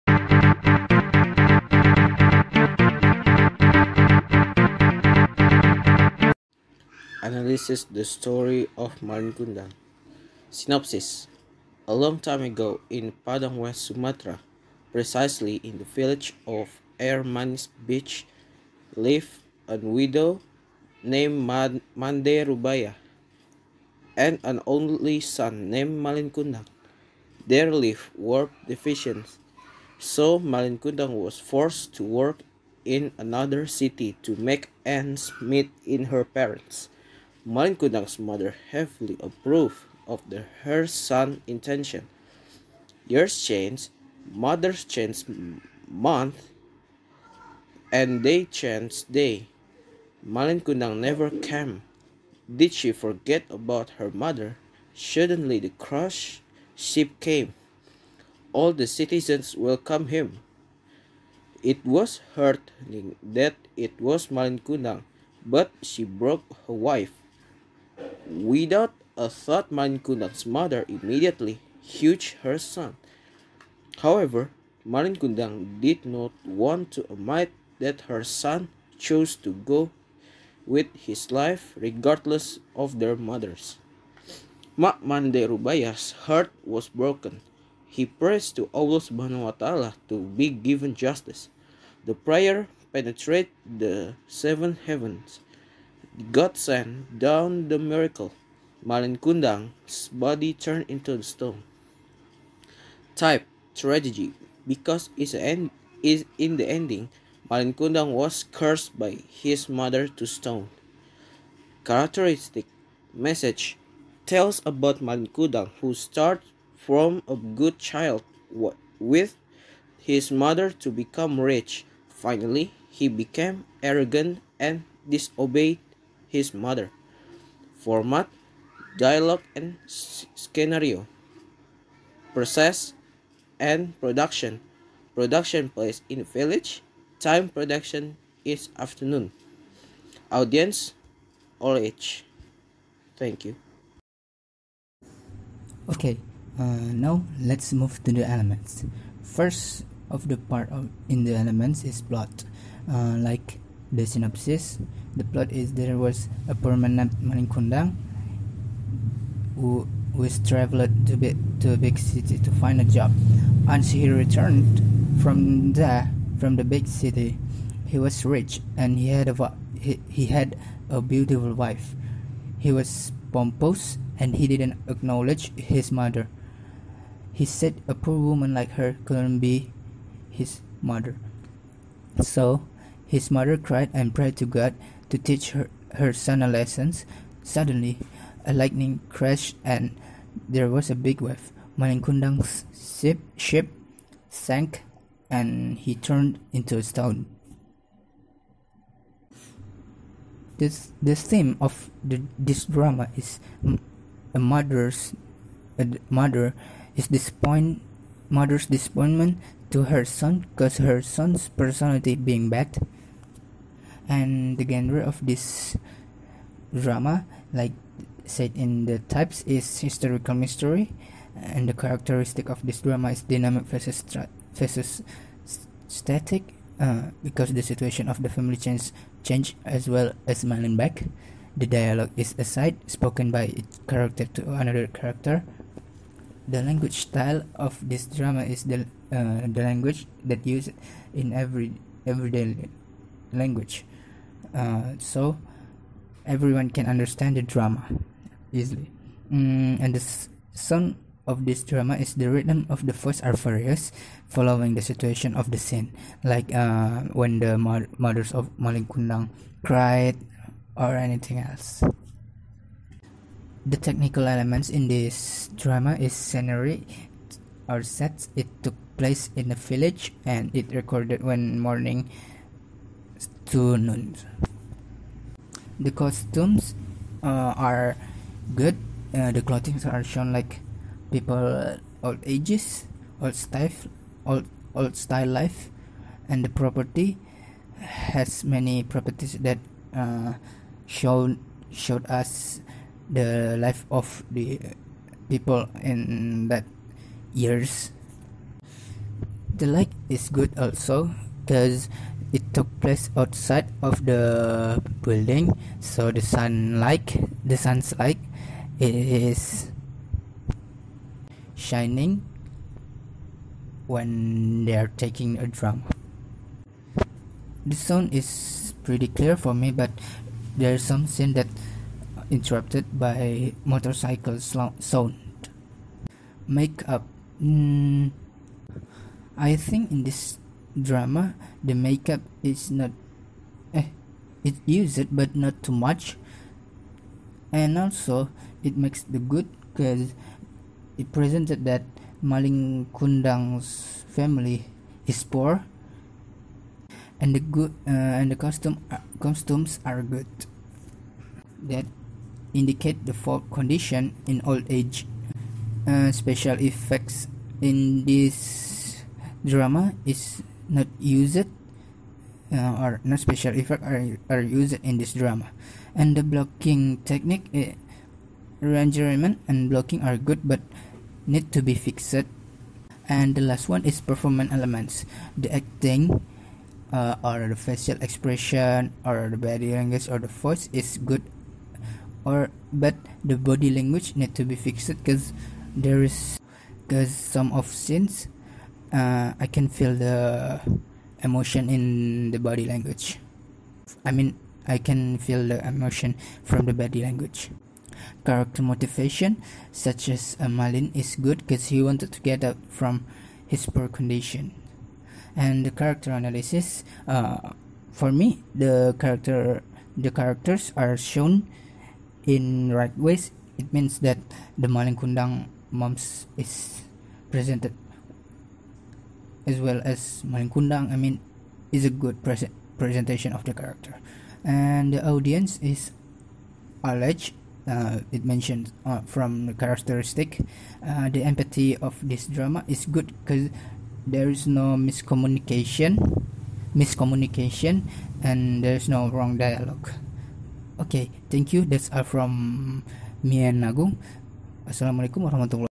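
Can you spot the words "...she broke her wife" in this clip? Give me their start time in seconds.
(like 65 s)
65 s.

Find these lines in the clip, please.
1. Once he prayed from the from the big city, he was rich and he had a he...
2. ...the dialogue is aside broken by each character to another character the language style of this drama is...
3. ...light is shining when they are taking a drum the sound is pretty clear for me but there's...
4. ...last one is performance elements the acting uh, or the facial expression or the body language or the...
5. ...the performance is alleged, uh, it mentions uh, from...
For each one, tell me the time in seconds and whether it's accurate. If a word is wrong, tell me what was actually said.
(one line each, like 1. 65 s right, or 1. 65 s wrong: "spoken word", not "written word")
1. 163 s wrong: "returned", not "prayed"
2. 231 s wrong: "spoken", not "broken"
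3. 307 s right
4. 373 s right
5. 424 s wrong: "audience", not "performance".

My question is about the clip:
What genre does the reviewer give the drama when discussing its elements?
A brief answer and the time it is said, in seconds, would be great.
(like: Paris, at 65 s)
Historical mystery, at 219 s.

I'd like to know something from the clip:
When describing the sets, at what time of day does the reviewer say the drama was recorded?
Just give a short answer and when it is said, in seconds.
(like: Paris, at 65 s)
Morning, at 271 s.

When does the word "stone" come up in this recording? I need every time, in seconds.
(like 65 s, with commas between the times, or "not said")
101 s, 110 s, 196 s.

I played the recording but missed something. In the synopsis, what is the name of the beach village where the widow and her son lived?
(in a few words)
Air Manis Beach.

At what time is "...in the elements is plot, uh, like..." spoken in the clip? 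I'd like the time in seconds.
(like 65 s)
151 s.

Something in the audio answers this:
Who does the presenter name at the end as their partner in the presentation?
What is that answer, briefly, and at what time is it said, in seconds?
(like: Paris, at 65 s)
Nagung, at 443 s.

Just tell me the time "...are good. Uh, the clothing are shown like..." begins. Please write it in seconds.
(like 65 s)
277 s.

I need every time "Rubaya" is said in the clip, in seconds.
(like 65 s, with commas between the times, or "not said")
22 s.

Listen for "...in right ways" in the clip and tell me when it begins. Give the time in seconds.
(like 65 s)
412 s.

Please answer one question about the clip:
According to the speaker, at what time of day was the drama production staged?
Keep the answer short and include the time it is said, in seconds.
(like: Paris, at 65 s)
Afternoon, at 138 s.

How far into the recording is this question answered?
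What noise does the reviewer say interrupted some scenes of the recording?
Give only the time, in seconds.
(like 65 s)
323 s.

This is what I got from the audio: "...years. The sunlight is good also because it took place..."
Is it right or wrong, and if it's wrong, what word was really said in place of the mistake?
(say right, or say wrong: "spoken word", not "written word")
wrong: "light", not "sunlight".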